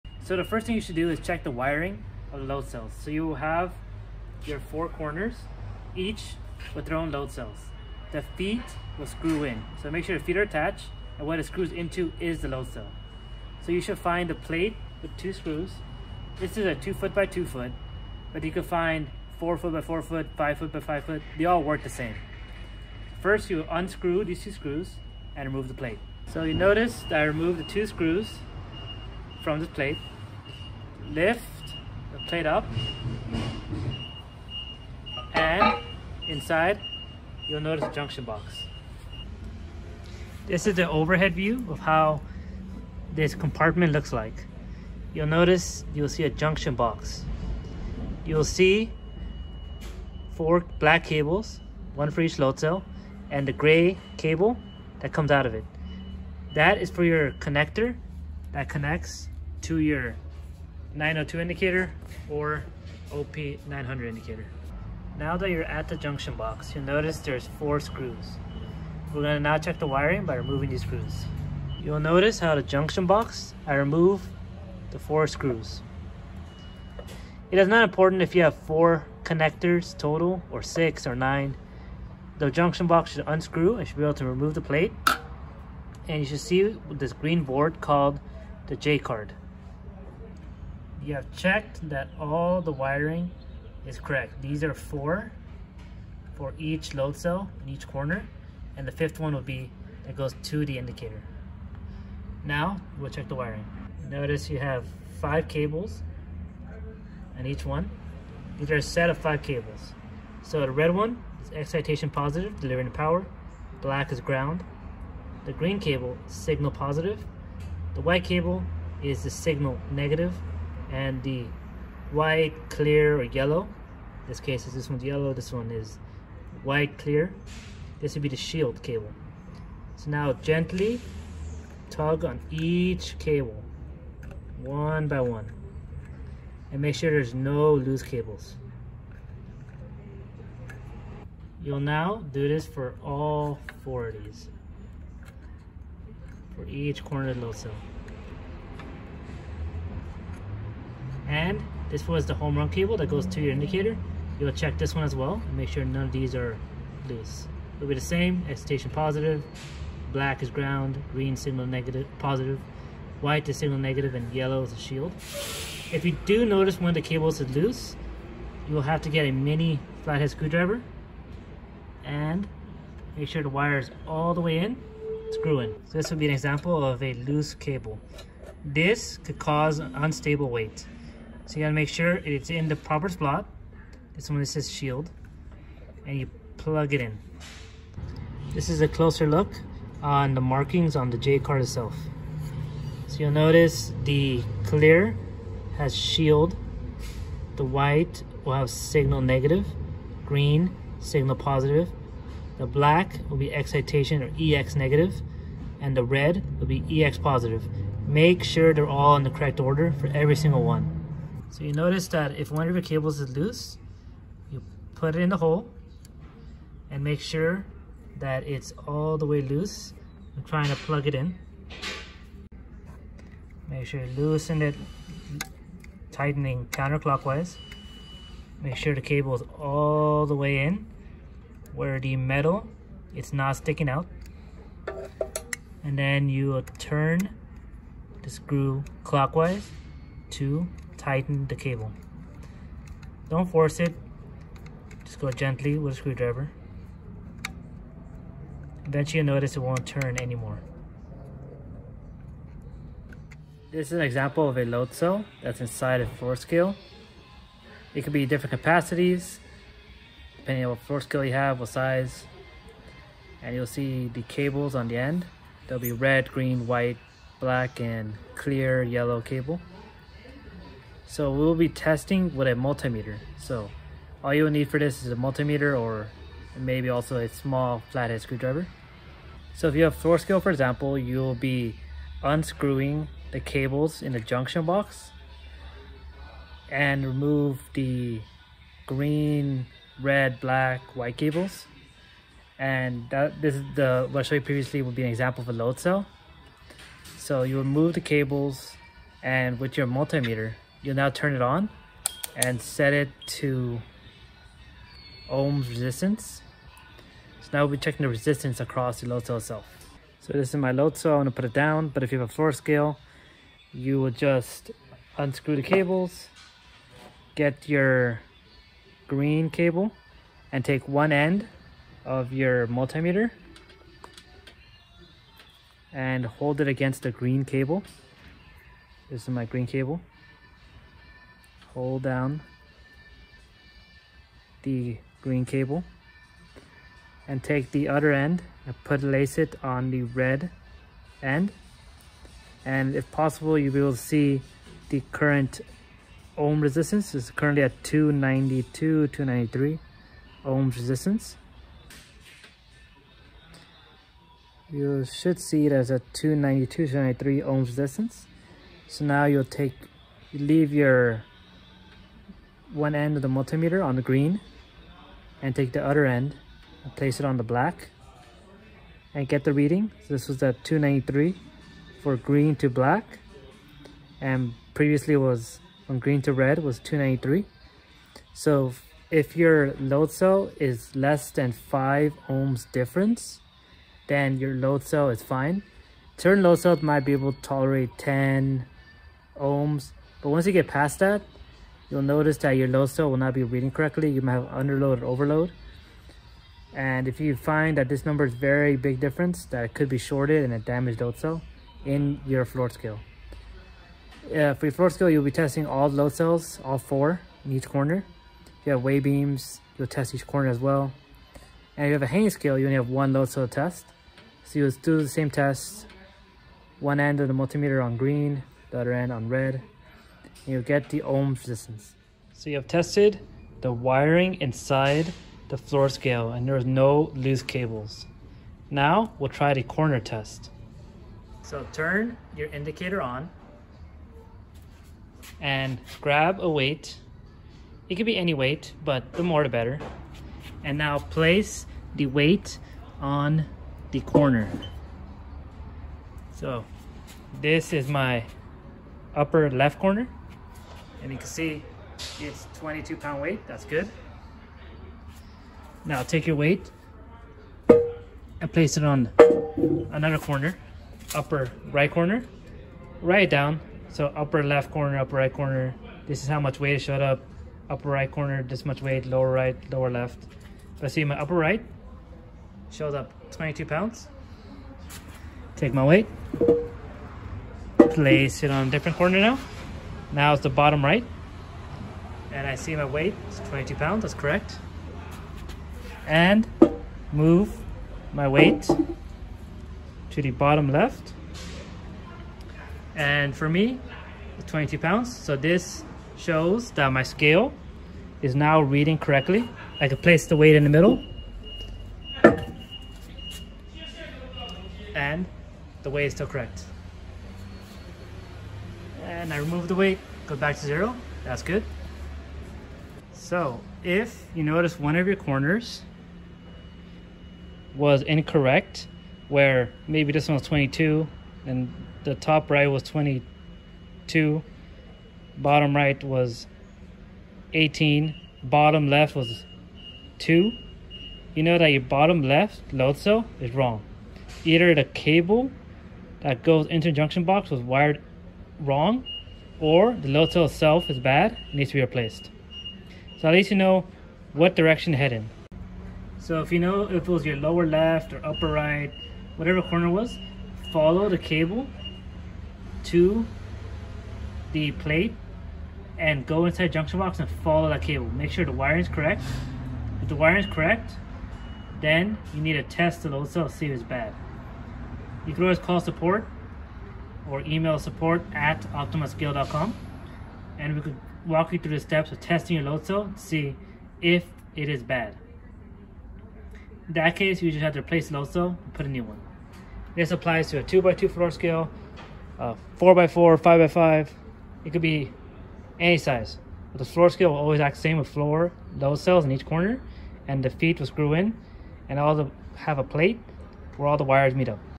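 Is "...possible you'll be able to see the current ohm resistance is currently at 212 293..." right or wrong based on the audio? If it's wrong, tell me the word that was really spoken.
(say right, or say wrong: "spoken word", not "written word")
wrong: "292", not "212".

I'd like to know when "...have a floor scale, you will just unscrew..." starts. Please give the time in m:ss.
5:12.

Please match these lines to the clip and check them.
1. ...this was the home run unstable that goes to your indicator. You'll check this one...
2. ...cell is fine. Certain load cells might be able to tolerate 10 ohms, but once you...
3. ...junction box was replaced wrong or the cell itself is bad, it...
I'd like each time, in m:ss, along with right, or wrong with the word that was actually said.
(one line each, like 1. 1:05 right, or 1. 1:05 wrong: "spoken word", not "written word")
1. 2:31 wrong: "cable", not "unstable"
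2. 6:24 right
3. 8:56 wrong: "wired", not "replaced".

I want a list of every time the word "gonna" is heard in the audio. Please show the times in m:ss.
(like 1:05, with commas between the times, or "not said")
1:09, 5:11.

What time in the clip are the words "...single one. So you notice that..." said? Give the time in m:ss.
3:30.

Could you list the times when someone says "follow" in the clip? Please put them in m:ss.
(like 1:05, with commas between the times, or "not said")
9:10, 9:17.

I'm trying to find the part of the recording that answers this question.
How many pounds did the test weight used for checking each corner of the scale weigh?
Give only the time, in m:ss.
7:32.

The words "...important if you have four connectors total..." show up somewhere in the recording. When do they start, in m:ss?
1:17.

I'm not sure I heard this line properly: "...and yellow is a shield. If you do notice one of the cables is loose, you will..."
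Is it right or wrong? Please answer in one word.
right.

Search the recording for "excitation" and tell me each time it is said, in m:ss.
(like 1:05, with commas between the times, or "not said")
1:51, 2:38, 3:23.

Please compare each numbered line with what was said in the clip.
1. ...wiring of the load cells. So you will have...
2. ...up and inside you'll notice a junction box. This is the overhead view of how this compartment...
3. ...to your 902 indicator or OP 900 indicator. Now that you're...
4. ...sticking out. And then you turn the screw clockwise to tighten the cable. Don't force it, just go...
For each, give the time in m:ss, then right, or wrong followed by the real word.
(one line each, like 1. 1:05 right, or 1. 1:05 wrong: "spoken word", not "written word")
1. 0:01 right
2. 0:32 right
3. 0:59 right
4. 3:53 right.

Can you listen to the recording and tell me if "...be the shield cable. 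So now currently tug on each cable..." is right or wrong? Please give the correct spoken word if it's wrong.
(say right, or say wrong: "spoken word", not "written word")
wrong: "gently", not "currently".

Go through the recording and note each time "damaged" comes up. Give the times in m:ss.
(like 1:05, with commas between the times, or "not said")
6:40.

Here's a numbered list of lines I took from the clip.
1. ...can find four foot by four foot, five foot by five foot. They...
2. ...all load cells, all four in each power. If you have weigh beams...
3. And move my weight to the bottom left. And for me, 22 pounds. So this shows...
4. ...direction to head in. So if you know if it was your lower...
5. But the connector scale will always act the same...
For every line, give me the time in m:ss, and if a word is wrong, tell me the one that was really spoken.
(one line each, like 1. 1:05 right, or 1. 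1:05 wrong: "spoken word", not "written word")
1. 0:18 right
2. 6:45 wrong: "corner", not "power"
3. 8:06 right
4. 9:04 right
5. 9:46 wrong: "floor", not "connector".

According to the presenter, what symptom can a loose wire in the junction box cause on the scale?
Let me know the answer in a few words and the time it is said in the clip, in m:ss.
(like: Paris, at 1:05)
Unstable weight, at 2:59.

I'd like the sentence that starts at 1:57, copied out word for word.
The white cable is the signal negative, and the white, clear, or yellow.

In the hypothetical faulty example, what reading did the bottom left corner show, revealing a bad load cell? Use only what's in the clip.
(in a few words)
2.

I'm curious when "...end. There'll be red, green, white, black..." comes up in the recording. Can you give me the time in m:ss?
4:24.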